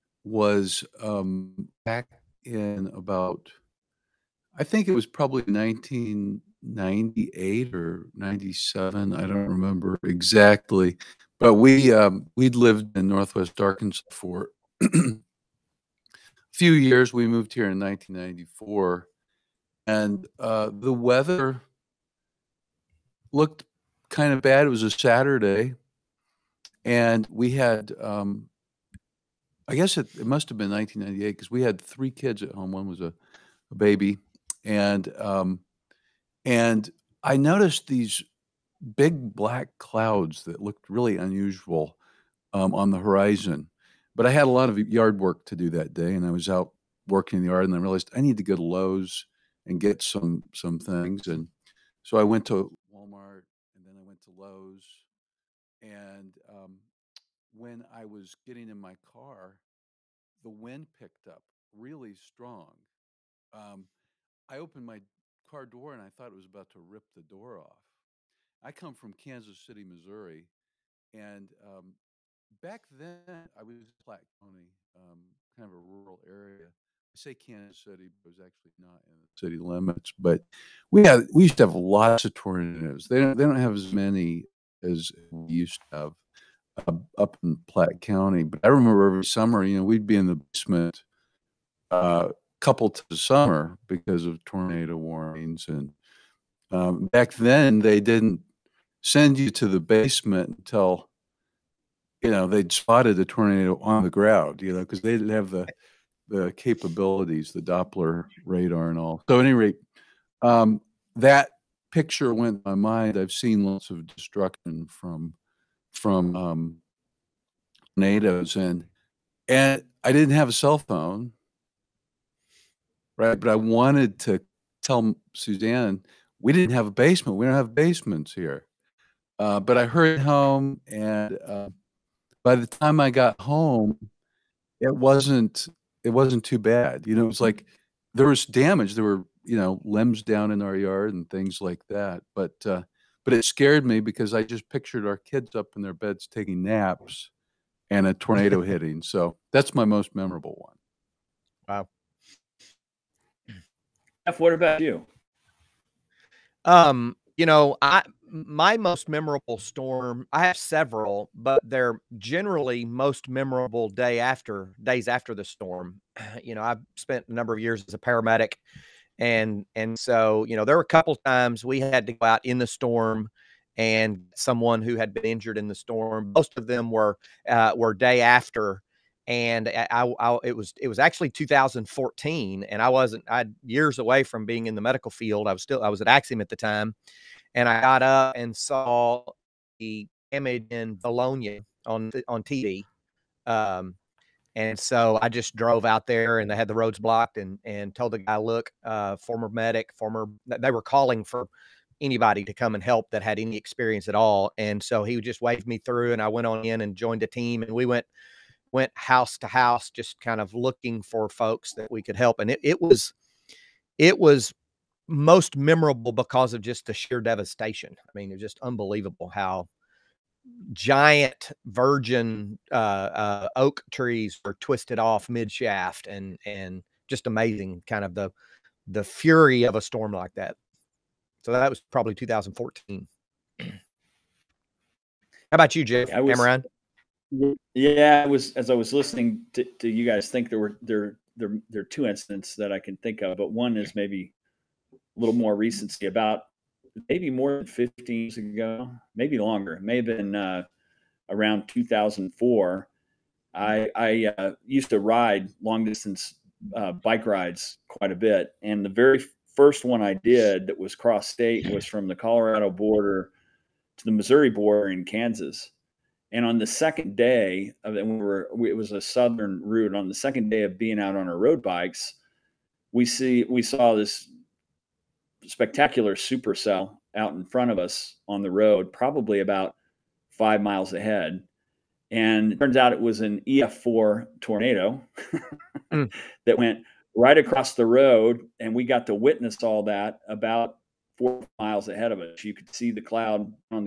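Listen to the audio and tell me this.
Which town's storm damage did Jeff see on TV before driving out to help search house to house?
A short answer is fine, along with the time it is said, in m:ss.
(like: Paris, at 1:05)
Vilonia, at 3:10.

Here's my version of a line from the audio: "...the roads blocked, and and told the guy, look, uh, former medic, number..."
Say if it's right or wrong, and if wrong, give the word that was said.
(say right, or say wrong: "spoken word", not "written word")
wrong: "former", not "number".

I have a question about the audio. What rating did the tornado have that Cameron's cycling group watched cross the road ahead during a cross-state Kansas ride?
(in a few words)
EF4.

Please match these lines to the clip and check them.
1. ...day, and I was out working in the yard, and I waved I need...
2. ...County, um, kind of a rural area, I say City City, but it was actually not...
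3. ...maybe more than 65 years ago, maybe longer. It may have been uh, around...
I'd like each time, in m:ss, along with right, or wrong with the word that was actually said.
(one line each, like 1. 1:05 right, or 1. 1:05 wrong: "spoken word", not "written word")
1. 0:45 wrong: "realized", not "waved"
2. 1:14 wrong: "Kansas", not "City"
3. 4:07 wrong: "15", not "65".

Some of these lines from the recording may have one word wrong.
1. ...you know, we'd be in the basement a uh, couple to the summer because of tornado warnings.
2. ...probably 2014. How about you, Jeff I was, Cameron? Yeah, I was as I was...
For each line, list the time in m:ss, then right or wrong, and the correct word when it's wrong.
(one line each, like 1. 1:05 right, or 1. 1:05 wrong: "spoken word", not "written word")
1. 1:29 right
2. 3:51 right.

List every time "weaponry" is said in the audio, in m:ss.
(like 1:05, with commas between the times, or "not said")
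not said.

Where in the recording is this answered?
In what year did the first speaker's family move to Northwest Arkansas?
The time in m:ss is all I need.
0:17.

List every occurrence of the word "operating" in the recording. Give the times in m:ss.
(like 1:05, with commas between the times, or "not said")
not said.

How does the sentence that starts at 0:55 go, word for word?
And um, when I was getting in my car, the wind picked up really strong.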